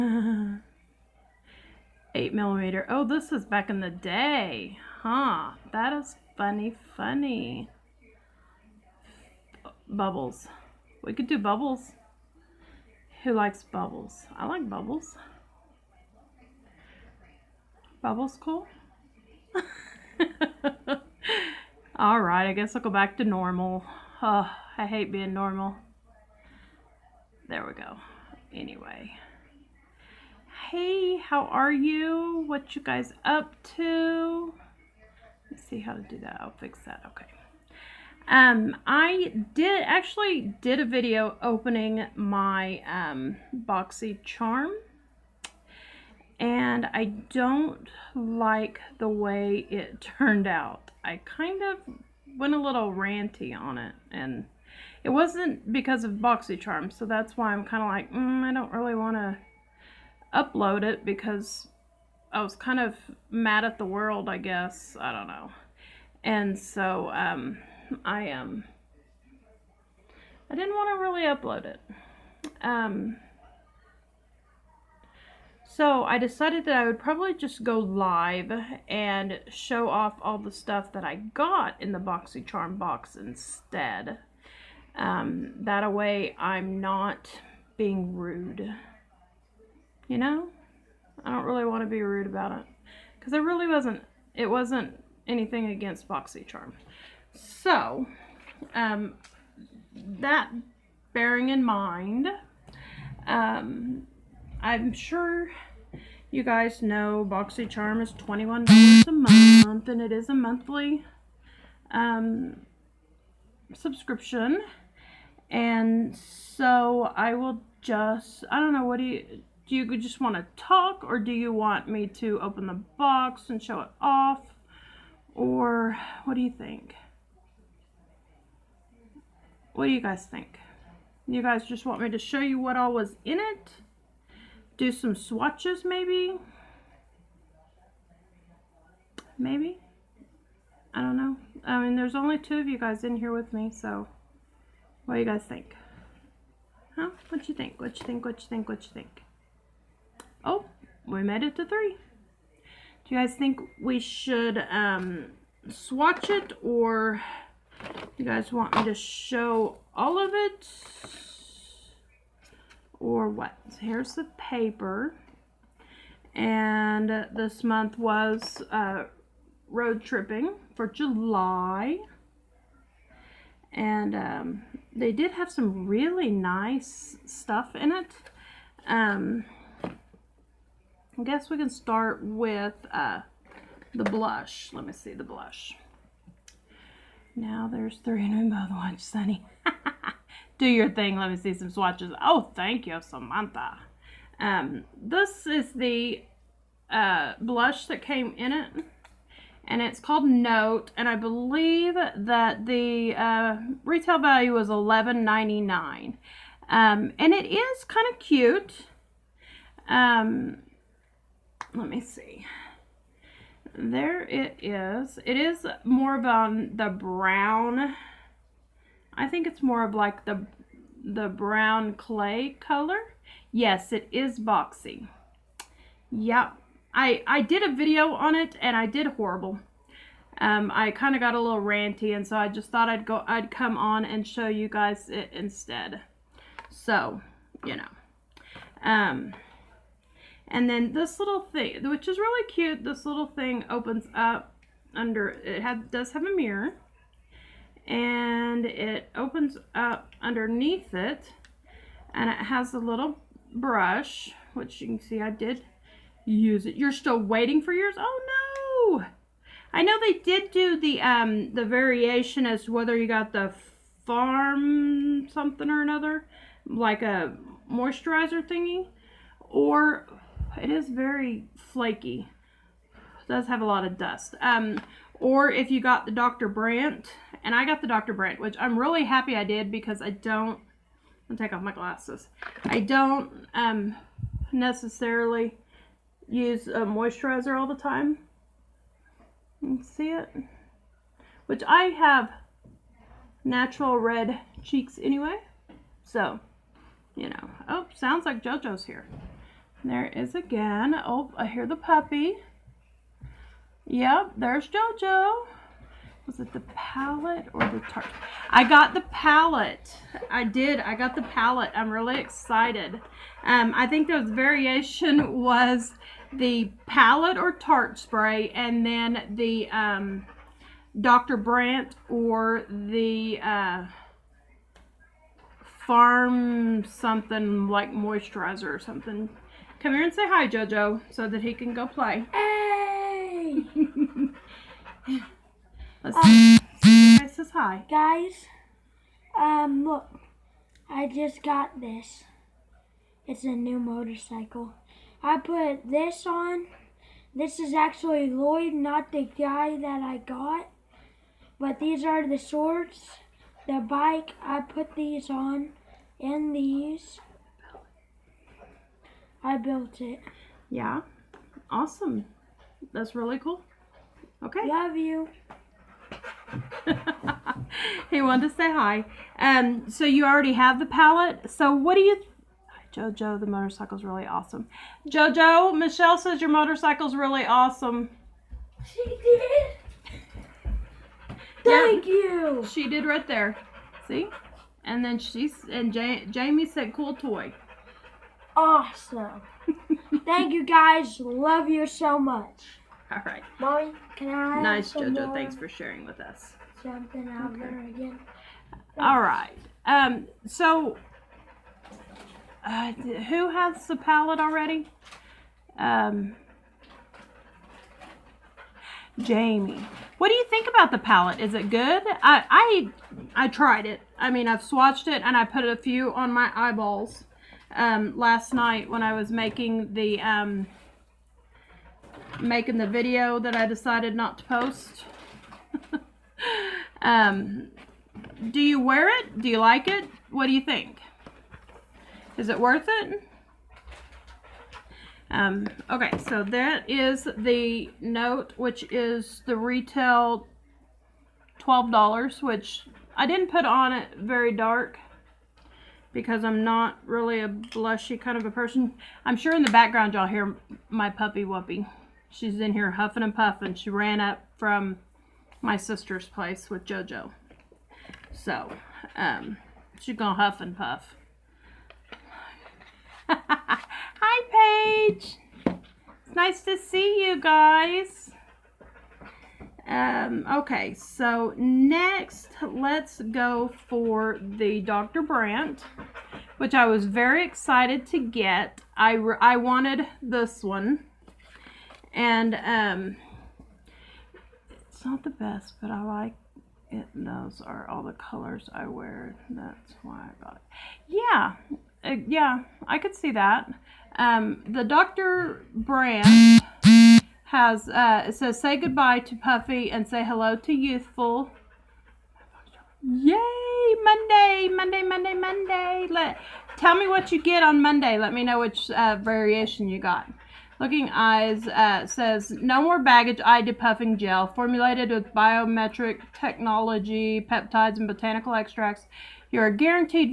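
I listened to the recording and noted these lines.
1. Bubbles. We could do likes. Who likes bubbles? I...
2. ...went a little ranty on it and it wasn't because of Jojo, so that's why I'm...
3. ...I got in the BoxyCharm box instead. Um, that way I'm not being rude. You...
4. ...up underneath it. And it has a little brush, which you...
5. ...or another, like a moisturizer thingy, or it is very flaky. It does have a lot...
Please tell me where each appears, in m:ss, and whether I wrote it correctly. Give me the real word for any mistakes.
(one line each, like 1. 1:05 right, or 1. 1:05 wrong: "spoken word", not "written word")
1. 0:09 wrong: "bubbles", not "likes"
2. 0:52 wrong: "BoxyCharm", not "Jojo"
3. 1:21 right
4. 4:09 right
5. 4:25 right.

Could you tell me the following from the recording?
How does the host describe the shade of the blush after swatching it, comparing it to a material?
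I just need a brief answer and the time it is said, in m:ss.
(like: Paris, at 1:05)
brown clay, at 3:41.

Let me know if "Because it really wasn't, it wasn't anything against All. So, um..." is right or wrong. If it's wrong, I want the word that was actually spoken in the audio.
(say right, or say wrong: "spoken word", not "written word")
wrong: "BoxyCharm", not "All".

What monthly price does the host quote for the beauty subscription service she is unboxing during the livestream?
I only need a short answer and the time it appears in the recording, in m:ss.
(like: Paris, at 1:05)
$21, at 1:48.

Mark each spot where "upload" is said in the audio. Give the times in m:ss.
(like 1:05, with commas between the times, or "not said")
1:00, 1:11.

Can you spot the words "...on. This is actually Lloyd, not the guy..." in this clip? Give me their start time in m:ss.
5:46.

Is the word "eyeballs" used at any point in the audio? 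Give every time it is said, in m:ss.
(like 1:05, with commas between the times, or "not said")
6:56.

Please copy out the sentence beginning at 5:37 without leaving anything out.
Guys, um, look, I just got this.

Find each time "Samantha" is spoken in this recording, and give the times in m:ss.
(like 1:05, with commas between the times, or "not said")
3:13.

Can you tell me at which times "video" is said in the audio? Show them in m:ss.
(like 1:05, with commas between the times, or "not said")
0:40, 3:47, 7:02.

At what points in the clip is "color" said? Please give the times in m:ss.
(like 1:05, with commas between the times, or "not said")
3:42, 8:08.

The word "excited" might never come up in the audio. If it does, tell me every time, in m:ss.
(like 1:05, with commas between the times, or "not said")
5:12, 7:57.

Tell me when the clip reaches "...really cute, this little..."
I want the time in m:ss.
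4:02.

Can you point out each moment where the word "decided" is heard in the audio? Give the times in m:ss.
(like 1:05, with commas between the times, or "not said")
1:16, 7:03.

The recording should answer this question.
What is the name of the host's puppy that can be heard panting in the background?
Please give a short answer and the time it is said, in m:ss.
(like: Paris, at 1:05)
Whoopi, at 7:31.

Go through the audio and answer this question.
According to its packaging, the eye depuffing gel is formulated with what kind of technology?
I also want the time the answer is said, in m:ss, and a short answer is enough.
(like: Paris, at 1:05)
biometric technology, at 8:35.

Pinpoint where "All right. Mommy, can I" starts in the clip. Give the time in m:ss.
6:33.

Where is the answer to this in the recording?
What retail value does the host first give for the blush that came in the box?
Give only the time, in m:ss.
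3:24.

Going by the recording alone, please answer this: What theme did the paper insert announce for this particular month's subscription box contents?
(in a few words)
road tripping.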